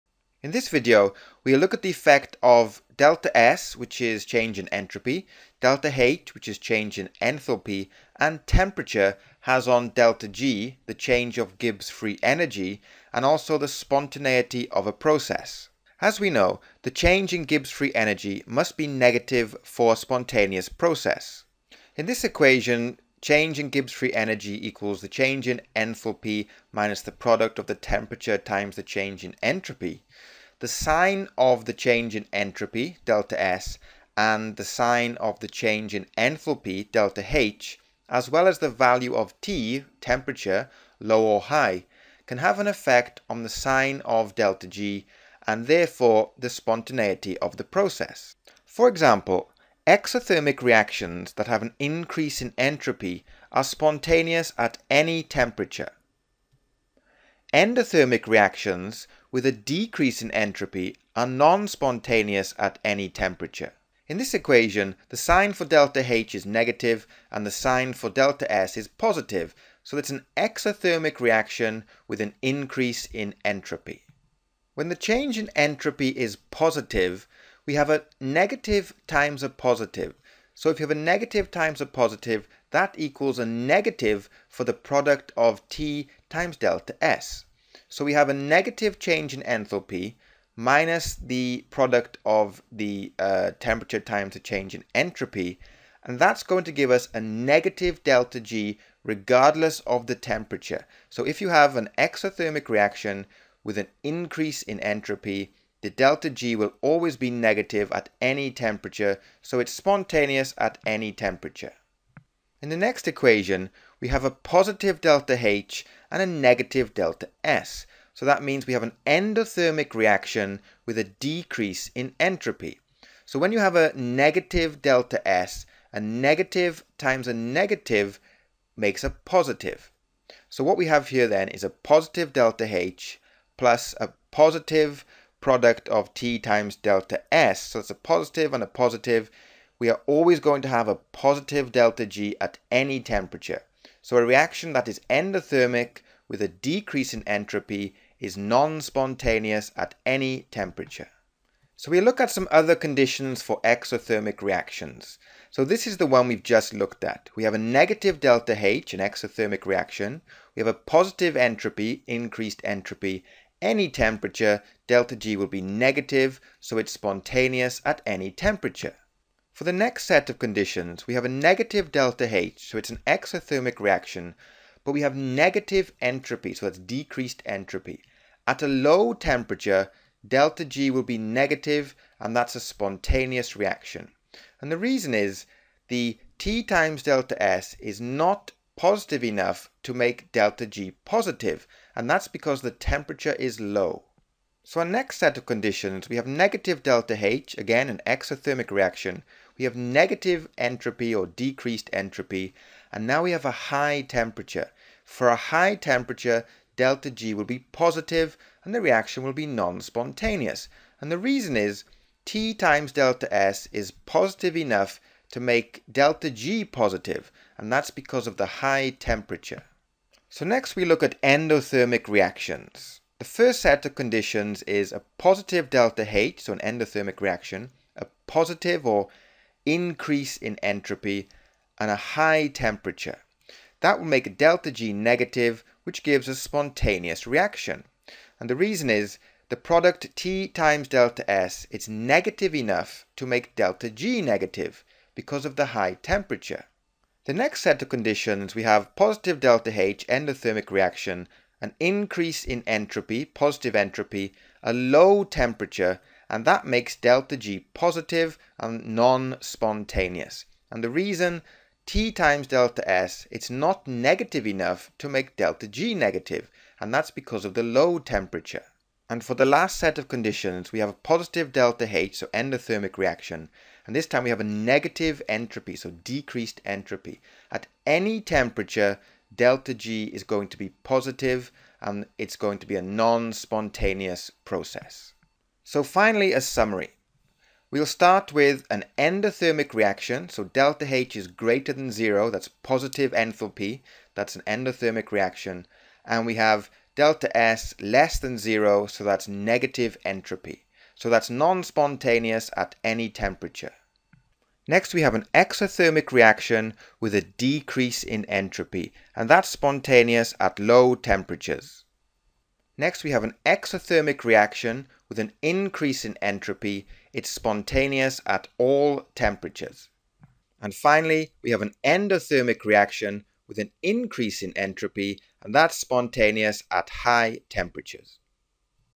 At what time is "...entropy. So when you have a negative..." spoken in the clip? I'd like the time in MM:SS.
02:02.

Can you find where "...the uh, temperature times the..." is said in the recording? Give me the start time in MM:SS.
01:32.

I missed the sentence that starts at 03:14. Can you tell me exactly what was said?
So our next set of conditions, we have negative delta H, again an exothermic reaction.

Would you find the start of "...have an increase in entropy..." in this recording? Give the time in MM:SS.
00:51.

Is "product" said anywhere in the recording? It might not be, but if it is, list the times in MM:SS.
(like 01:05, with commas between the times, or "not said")
00:27, 01:24, 01:31, 02:15, 03:59.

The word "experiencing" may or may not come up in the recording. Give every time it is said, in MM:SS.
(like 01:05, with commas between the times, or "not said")
not said.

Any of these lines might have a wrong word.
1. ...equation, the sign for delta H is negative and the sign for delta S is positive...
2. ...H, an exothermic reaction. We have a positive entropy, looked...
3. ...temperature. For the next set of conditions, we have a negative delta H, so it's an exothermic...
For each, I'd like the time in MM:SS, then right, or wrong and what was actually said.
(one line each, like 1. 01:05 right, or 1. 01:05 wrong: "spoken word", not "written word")
1. 01:04 right
2. 02:38 wrong: "increased", not "looked"
3. 02:48 right.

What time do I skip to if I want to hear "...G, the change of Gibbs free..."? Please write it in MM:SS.
00:10.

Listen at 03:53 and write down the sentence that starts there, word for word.
That will make delta G negative, which gives a spontaneous reaction.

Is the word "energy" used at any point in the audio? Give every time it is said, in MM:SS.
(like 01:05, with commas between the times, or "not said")
00:12, 00:17, 00:24.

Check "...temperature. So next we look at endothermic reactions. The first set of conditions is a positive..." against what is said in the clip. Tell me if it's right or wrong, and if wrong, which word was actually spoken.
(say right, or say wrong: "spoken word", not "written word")
right.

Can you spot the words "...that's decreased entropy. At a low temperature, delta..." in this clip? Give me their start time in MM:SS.
02:56.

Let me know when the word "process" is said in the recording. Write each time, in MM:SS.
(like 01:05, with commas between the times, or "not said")
00:14, 00:20, 00:47, 04:44.